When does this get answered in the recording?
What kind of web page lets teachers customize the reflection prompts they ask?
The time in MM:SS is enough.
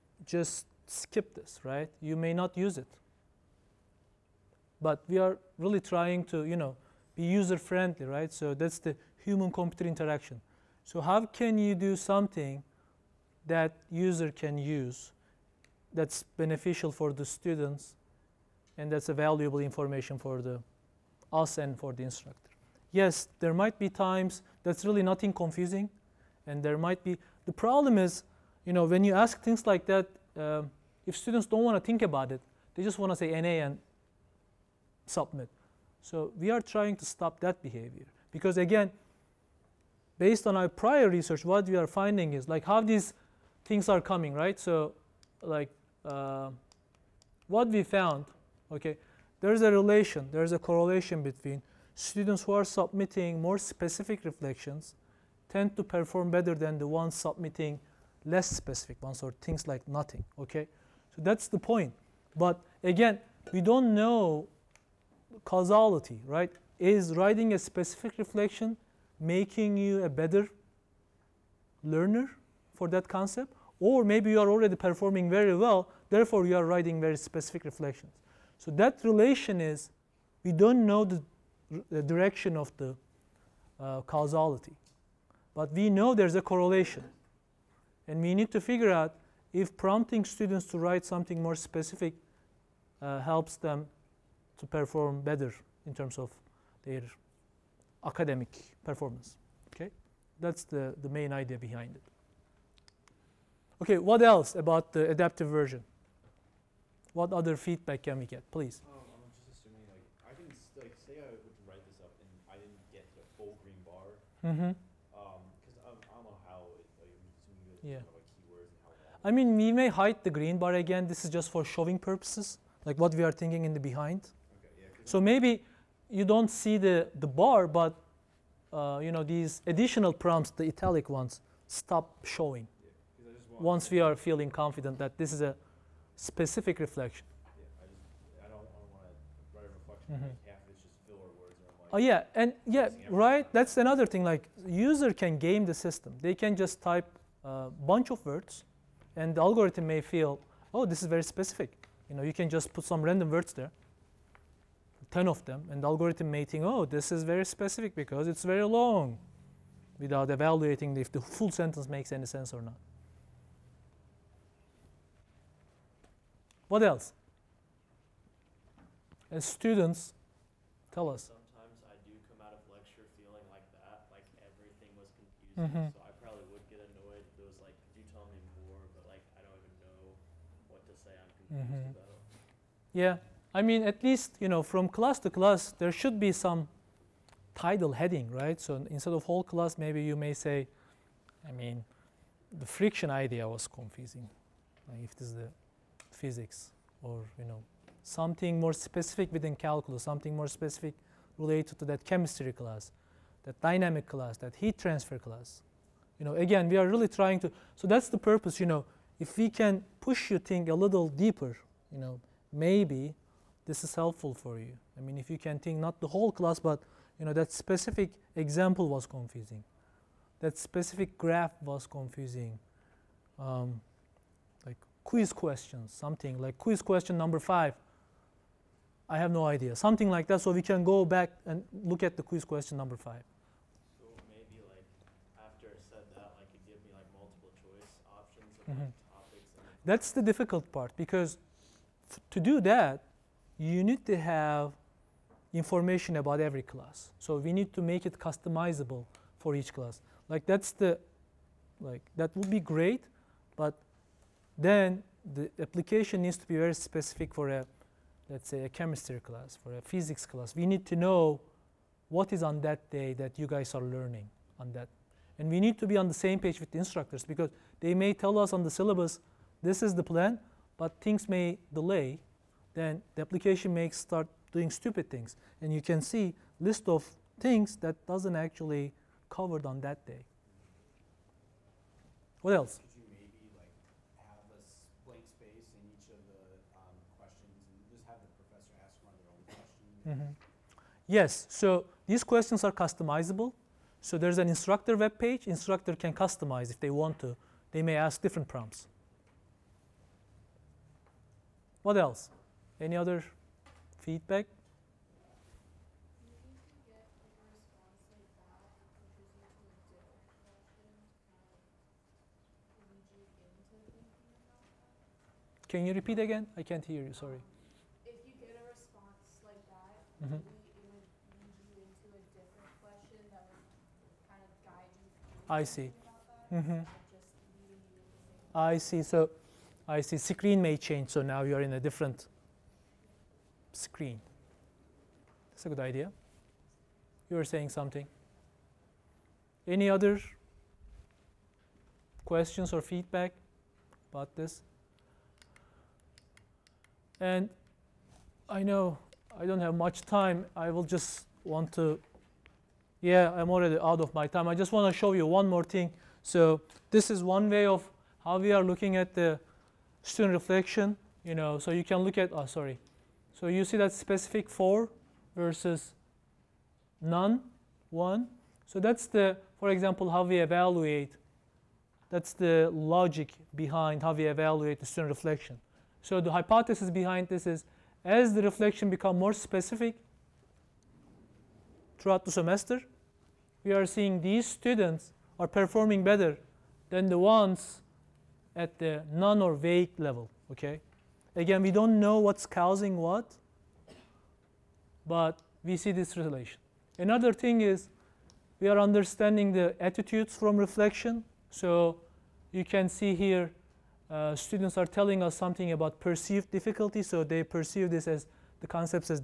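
04:54.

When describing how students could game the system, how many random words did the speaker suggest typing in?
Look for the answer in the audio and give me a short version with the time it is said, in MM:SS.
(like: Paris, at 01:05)
10, at 02:35.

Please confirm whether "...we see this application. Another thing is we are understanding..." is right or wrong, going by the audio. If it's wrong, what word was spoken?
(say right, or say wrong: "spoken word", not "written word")
wrong: "relation", not "application".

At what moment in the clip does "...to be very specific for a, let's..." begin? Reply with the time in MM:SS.
04:16.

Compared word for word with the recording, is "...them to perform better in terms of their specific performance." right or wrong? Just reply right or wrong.
wrong.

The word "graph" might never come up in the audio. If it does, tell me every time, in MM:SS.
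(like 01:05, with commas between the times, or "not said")
03:41.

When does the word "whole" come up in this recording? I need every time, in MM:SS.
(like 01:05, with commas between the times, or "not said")
03:09, 03:36.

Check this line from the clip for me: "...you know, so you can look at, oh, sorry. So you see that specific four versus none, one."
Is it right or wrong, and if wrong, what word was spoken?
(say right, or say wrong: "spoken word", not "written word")
right.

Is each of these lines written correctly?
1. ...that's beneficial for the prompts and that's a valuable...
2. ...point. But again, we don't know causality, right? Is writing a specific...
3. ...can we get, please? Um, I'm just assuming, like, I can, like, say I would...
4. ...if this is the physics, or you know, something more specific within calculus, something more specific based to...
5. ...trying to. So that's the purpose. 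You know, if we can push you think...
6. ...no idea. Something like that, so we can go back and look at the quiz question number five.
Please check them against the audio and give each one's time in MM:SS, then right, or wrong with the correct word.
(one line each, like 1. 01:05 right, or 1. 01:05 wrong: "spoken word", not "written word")
1. 00:15 wrong: "students", not "prompts"
2. 01:01 right
3. 01:48 right
4. 03:15 wrong: "related", not "based"
5. 03:27 right
6. 03:49 right.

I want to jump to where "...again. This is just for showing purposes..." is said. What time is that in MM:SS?
02:00.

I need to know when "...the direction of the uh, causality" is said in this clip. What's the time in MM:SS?
01:21.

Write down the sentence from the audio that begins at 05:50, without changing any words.
I will just want to, yeah, I'm already out of my time.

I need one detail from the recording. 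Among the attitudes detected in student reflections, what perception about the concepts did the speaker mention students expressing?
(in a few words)
perceived difficulty.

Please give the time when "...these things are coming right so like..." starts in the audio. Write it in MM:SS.
00:42.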